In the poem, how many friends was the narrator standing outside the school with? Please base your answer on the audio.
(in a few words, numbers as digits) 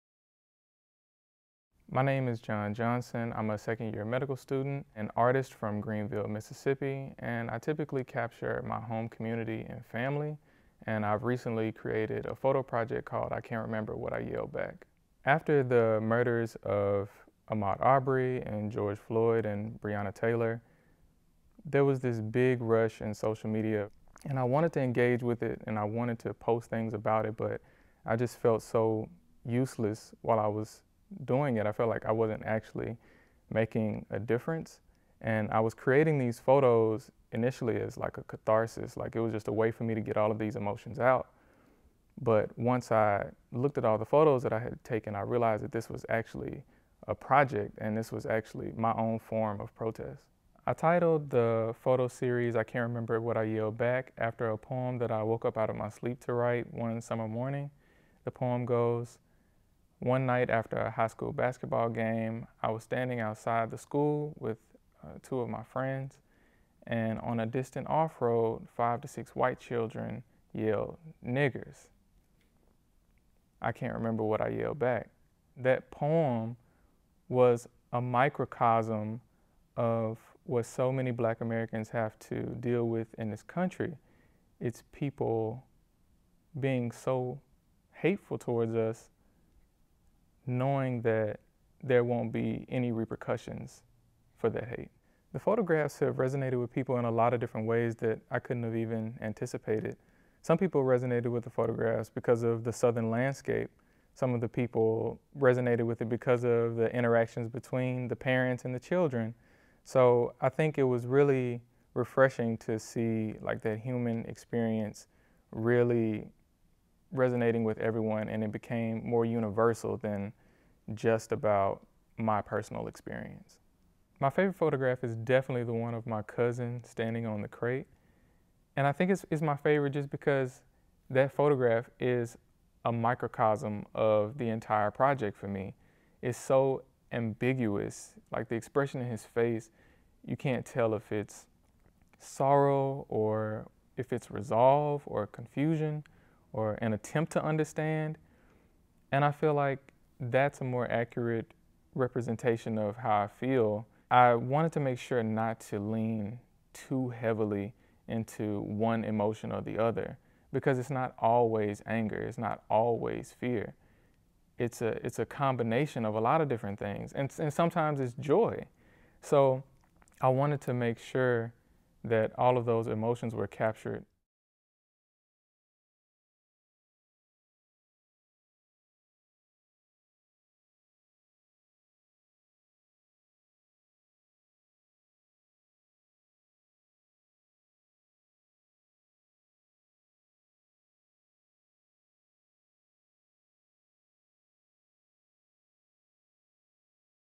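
2.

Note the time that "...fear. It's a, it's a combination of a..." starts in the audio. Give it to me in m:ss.
2:43.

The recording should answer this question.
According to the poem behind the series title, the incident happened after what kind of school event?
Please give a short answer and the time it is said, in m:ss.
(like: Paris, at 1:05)
high school basketball game, at 1:00.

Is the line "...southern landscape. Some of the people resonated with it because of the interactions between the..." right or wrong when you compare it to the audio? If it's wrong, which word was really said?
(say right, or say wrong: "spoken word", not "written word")
right.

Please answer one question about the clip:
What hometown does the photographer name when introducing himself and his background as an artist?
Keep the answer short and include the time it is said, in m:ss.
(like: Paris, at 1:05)
Greenville, Mississippi, at 0:05.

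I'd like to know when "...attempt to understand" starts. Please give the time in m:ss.
2:26.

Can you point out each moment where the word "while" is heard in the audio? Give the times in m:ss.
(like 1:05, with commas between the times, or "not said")
0:30.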